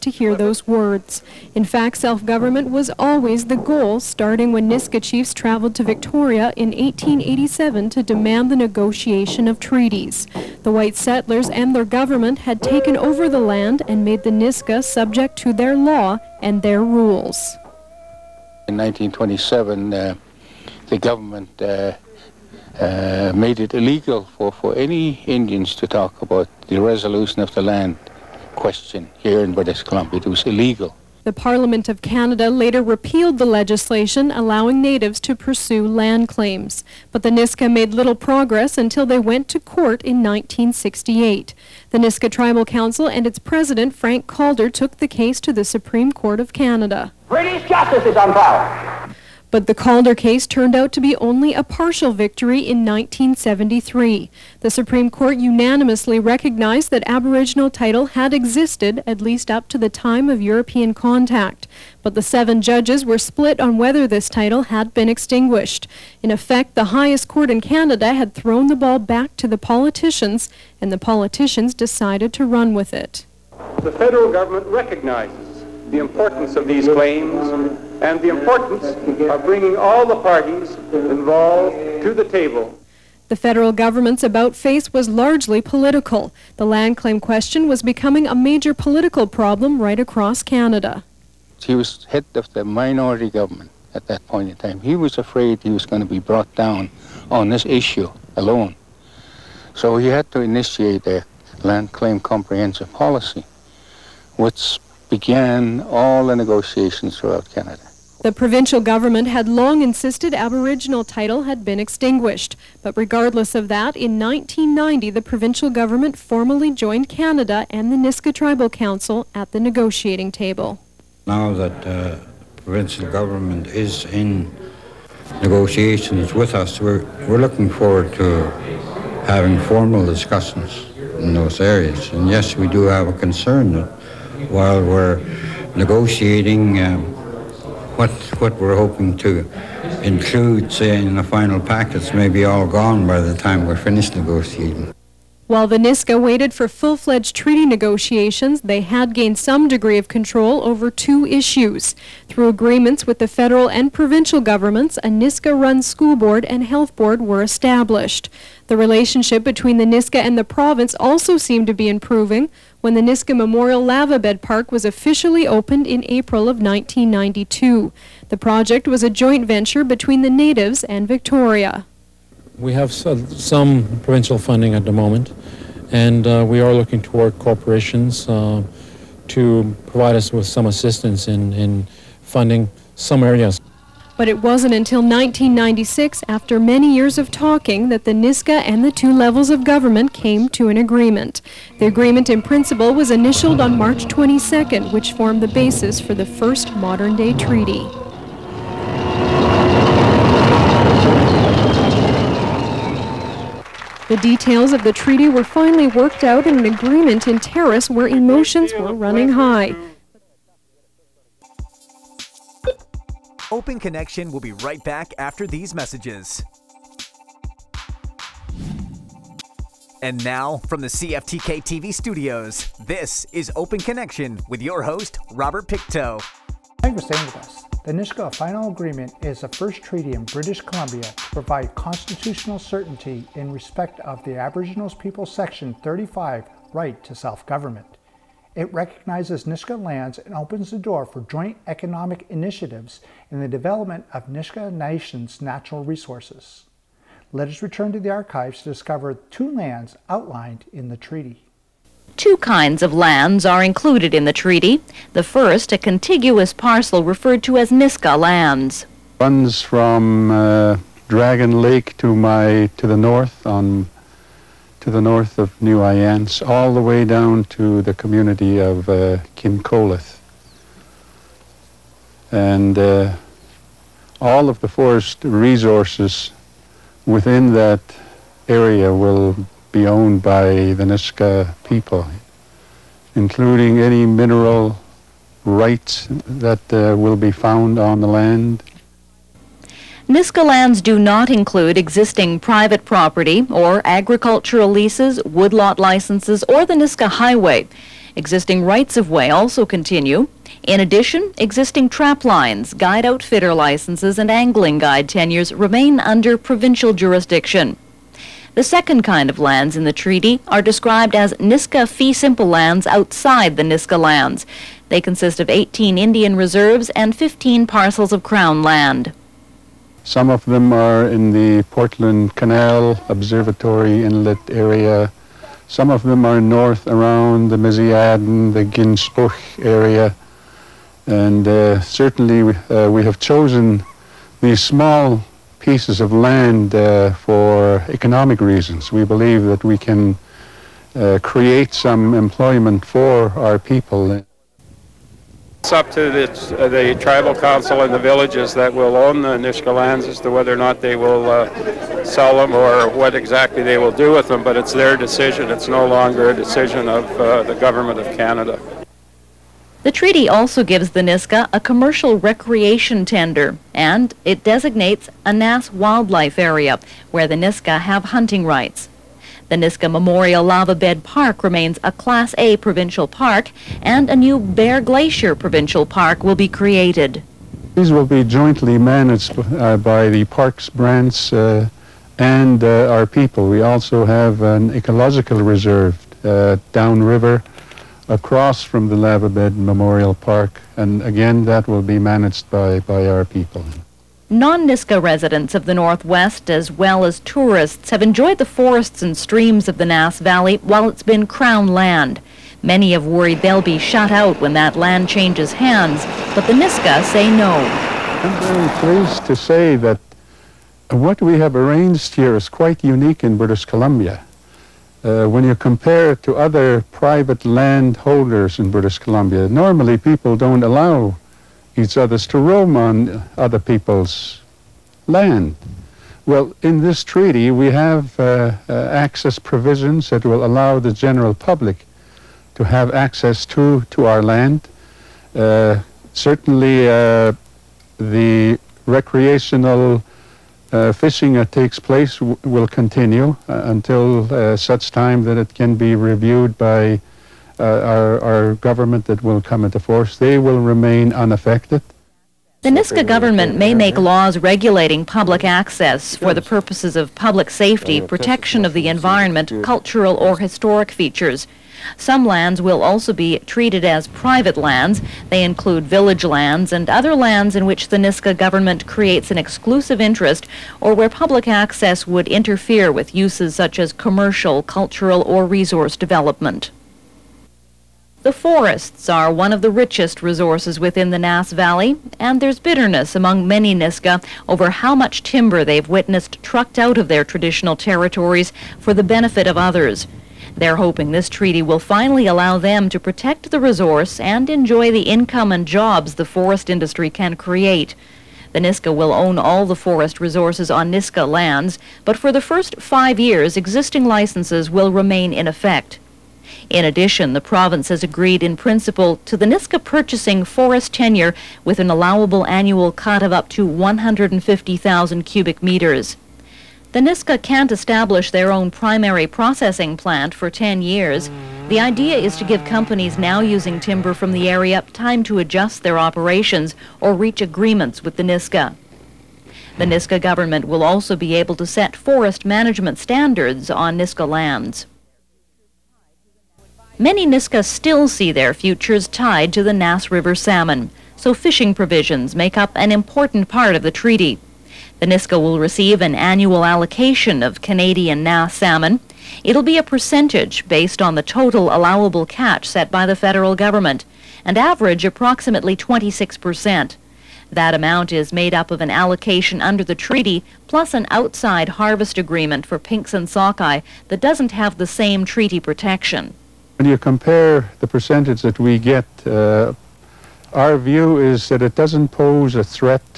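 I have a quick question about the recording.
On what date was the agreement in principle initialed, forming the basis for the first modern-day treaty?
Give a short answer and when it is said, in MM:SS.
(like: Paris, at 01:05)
March 22, at 03:13.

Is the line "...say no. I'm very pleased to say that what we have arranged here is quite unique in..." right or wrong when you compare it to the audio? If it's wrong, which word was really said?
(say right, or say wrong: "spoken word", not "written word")
right.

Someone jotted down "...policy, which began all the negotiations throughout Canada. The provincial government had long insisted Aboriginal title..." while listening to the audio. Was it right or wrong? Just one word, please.
right.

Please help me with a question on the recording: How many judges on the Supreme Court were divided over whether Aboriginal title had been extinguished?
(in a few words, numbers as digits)
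7.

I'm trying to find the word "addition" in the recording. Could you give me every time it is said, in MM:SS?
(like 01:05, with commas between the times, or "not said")
05:00, 08:26.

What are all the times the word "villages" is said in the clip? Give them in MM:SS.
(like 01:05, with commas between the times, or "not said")
05:47, 07:45.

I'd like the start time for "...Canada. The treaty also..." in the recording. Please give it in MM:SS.
05:58.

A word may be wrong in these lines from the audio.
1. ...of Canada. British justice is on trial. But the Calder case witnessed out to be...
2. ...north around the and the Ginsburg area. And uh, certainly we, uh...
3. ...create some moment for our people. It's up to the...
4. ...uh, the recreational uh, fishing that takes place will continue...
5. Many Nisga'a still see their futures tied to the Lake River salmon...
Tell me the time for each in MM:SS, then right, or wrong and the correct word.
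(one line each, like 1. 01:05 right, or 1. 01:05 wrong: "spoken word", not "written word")
1. 00:46 wrong: "turned", not "witnessed"
2. 05:26 right
3. 05:41 wrong: "employment", not "moment"
4. 07:16 right
5. 08:56 wrong: "Nass", not "Lake".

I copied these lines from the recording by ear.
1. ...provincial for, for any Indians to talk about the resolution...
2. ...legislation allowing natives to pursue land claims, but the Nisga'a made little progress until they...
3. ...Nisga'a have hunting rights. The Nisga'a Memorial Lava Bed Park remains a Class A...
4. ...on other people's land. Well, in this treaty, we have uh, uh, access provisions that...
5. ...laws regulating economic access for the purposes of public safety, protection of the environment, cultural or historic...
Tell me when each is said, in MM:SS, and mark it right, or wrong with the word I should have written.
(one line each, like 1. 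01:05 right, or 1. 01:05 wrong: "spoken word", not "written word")
1. 00:23 wrong: "illegal", not "provincial"
2. 00:33 right
3. 06:07 right
4. 07:02 right
5. 07:33 wrong: "public", not "economic".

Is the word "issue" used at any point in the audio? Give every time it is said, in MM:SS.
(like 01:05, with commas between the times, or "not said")
01:37, 02:31.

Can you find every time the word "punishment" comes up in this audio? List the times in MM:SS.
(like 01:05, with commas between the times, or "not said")
not said.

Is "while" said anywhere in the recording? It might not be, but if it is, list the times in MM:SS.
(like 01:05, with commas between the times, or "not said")
02:14, 02:25, 06:40.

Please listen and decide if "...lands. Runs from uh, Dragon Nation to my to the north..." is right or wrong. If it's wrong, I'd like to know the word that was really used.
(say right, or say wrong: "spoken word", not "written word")
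wrong: "Lake", not "Nation".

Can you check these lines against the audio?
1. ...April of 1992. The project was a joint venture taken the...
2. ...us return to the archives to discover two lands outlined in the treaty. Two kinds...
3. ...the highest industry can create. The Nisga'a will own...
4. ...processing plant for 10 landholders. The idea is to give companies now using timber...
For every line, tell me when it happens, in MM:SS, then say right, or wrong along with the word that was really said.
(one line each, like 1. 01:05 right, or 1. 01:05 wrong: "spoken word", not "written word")
1. 02:46 wrong: "between", not "taken"
2. 04:07 right
3. 08:16 wrong: "forest", not "highest"
4. 08:39 wrong: "years", not "landholders".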